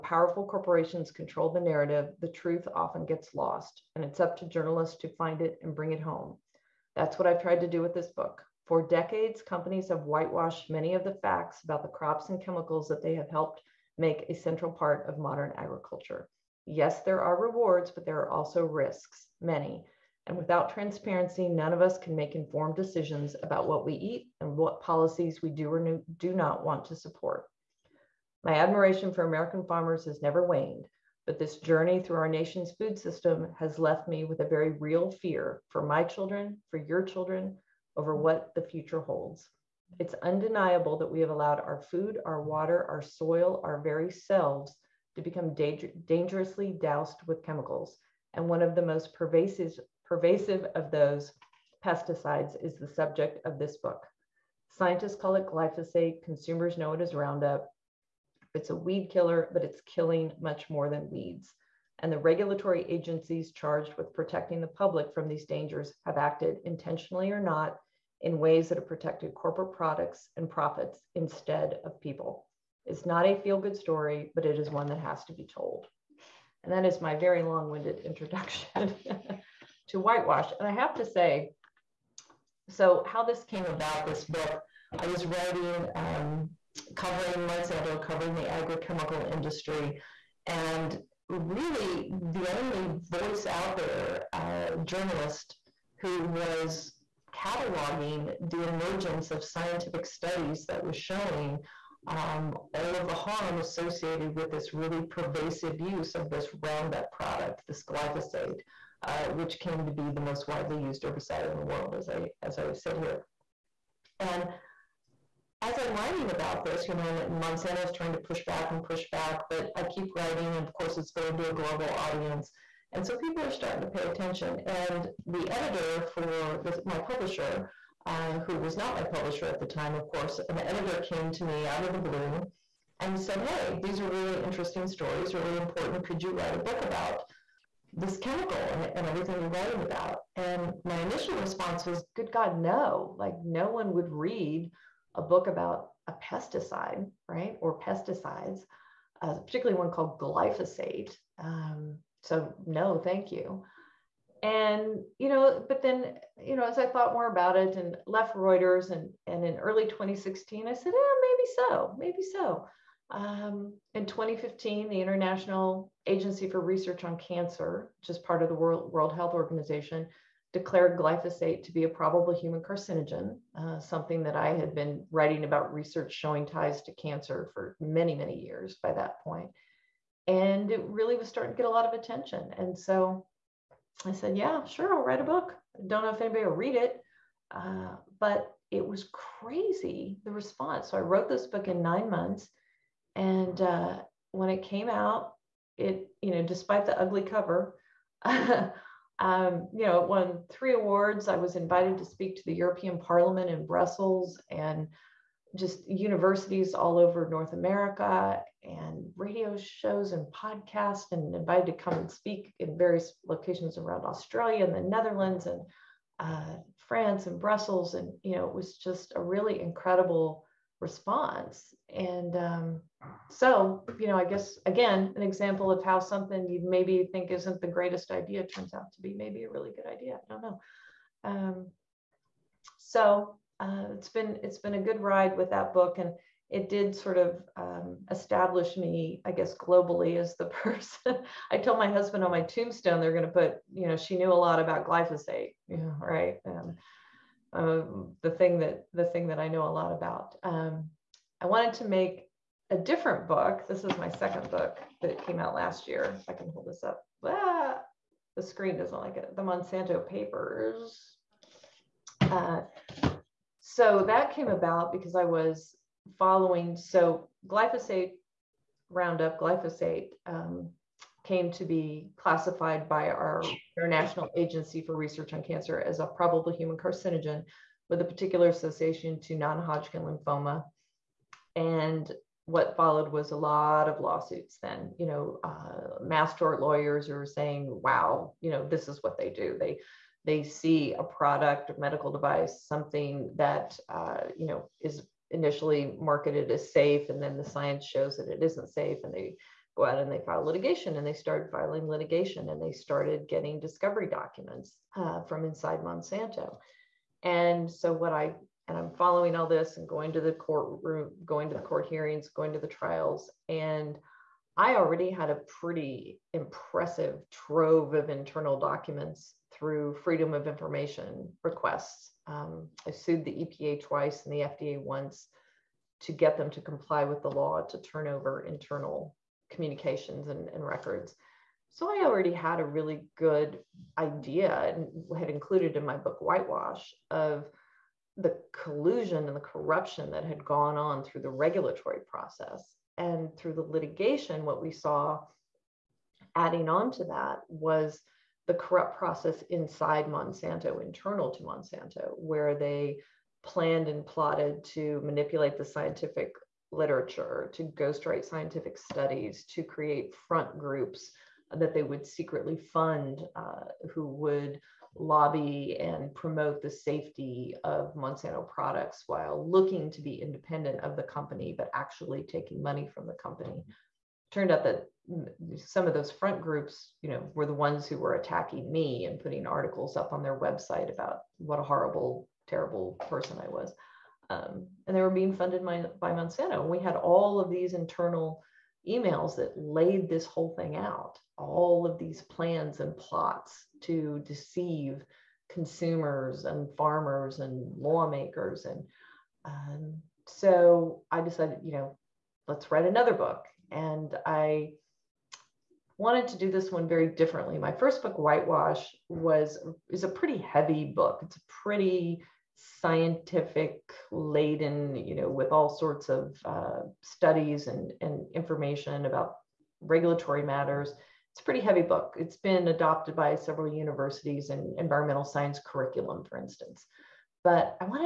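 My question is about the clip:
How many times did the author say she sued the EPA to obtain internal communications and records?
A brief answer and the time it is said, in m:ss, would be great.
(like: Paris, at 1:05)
2, at 5:23.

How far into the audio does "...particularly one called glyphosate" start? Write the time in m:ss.
2:29.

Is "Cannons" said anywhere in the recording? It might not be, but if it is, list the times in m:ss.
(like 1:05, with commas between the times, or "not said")
not said.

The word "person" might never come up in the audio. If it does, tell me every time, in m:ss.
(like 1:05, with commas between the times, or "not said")
4:00, 6:23.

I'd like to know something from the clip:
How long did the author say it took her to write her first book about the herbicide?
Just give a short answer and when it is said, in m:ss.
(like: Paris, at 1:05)
9 months, at 3:11.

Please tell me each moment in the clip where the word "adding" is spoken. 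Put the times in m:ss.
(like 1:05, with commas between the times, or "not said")
5:46.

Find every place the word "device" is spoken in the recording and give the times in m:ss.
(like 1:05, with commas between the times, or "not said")
4:52.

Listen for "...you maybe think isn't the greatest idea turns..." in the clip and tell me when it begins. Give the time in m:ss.
3:46.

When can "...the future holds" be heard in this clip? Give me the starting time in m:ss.
0:38.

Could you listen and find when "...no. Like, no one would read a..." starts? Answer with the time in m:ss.
2:22.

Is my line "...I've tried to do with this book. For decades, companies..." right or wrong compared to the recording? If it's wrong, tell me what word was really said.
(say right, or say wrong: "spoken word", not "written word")
right.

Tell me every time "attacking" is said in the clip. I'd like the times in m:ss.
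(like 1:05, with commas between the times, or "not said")
6:18.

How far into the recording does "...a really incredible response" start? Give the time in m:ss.
3:39.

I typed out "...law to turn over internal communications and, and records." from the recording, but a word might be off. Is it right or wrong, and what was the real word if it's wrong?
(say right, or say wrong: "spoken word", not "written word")
right.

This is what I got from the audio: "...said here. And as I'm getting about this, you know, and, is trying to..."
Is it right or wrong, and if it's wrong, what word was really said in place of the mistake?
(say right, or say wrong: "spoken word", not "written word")
wrong: "writing", not "getting".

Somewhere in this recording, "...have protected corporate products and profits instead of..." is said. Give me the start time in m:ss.
1:08.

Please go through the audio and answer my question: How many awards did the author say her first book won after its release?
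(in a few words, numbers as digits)
3.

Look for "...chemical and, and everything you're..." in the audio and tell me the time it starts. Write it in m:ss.
2:18.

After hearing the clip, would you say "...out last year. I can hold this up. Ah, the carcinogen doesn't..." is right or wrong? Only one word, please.
wrong.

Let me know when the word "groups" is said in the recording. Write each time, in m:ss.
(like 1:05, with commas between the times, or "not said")
6:00, 6:16.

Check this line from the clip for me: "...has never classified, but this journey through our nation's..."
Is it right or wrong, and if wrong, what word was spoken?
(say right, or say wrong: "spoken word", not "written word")
wrong: "waned", not "classified".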